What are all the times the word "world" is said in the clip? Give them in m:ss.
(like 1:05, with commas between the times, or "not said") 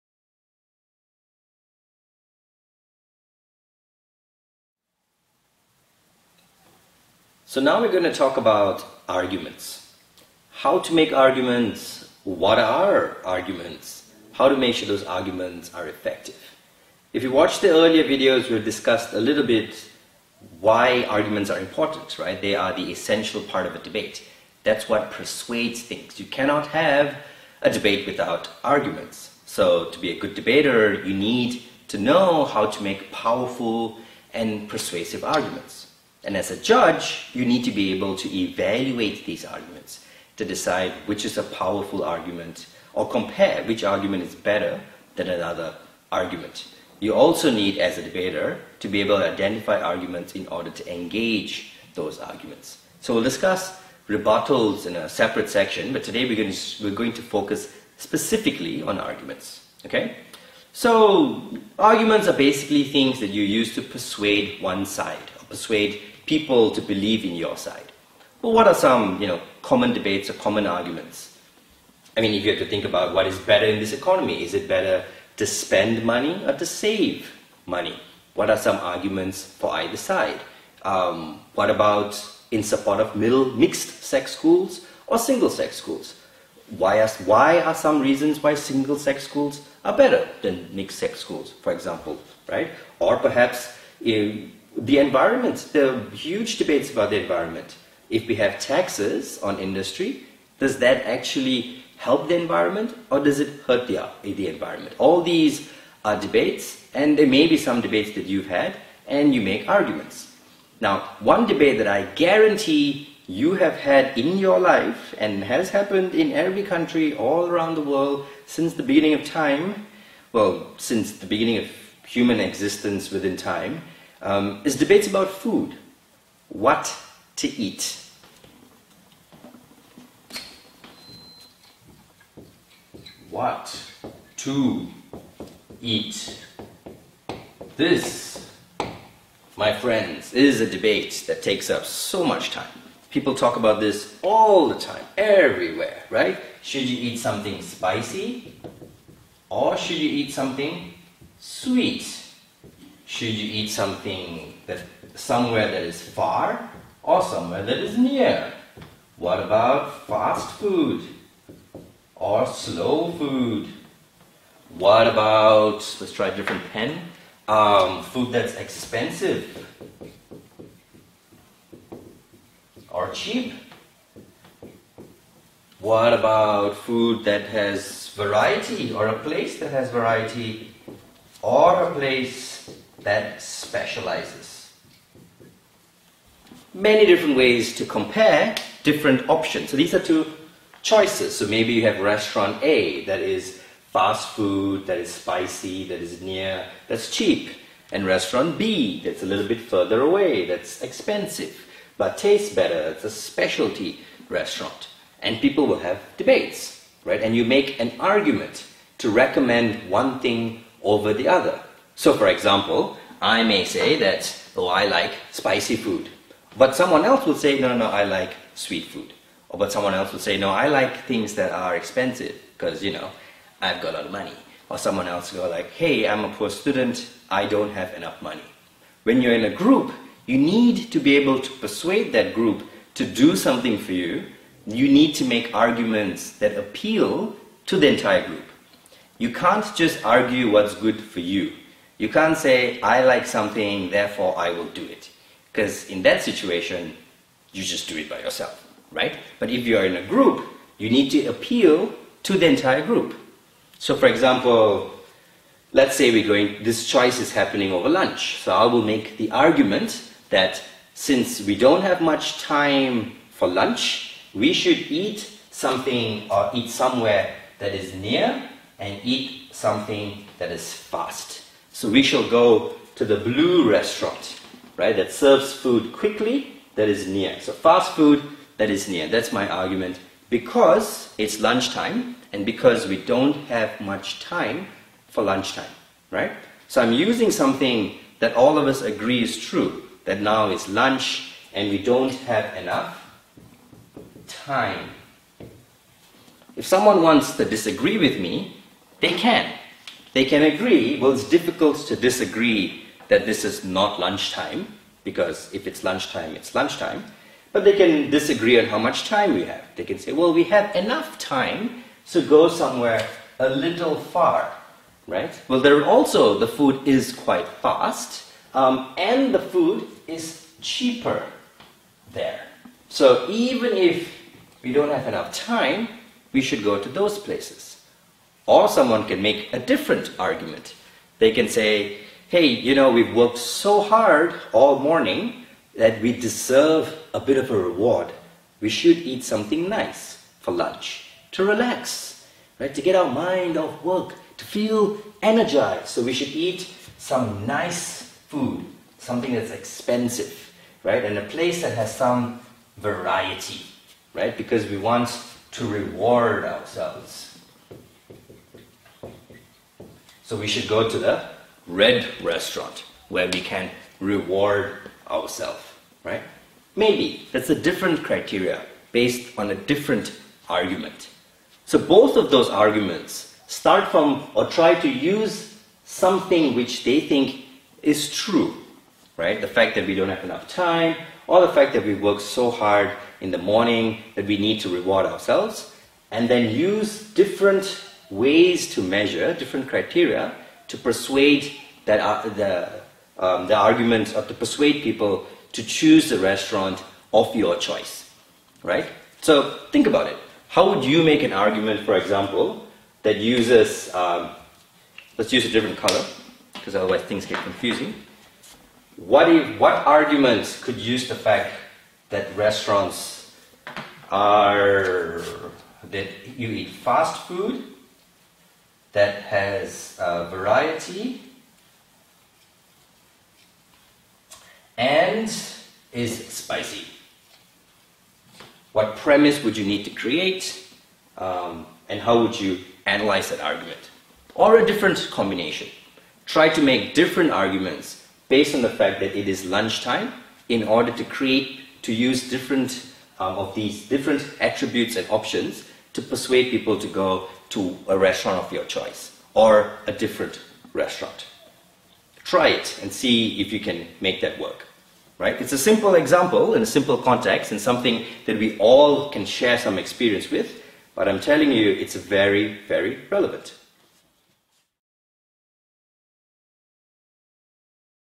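1:57.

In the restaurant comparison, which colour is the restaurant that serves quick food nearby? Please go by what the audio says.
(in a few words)
blue.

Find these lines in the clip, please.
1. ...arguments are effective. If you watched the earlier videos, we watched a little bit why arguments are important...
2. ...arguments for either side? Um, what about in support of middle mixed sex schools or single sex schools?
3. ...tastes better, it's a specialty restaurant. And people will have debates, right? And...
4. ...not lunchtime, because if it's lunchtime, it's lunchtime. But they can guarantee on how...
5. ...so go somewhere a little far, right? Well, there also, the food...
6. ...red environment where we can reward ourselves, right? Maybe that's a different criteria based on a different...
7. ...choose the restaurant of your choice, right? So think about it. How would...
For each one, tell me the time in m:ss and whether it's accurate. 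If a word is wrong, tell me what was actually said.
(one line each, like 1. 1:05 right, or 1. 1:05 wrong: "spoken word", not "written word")
1. 0:15 wrong: "discussed", not "watched"
2. 1:18 right
3. 3:22 right
4. 5:03 wrong: "disagree", not "guarantee"
5. 5:12 right
6. 6:01 wrong: "restaurant", not "environment"
7. 6:35 right.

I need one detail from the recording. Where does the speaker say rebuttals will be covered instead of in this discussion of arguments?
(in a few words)
a separate section.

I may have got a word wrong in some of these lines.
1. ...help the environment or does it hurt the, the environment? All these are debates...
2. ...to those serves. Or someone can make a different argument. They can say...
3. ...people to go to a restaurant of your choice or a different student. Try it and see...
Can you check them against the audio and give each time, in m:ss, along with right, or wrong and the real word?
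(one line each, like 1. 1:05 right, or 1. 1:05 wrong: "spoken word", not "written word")
1. 1:41 right
2. 5:26 wrong: "places", not "serves"
3. 7:26 wrong: "restaurant", not "student".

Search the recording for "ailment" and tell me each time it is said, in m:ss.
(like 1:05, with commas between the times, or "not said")
not said.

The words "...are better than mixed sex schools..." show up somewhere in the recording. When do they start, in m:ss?
1:29.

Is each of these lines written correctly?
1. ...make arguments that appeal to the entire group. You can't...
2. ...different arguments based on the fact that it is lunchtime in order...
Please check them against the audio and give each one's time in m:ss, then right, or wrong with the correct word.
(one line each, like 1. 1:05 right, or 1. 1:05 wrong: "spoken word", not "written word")
1. 3:55 right
2. 7:16 right.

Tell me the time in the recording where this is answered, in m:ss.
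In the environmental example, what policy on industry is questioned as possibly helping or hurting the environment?
1:38.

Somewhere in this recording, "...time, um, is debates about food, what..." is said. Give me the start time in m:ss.
2:03.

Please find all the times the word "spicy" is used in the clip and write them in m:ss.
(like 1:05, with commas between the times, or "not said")
2:27, 3:15, 3:35, 7:06.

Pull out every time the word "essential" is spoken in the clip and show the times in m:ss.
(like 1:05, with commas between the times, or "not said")
0:22.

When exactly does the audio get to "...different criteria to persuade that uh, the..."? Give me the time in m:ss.
6:29.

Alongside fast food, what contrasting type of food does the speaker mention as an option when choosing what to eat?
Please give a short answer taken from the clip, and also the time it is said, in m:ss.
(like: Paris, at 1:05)
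slow food, at 2:42.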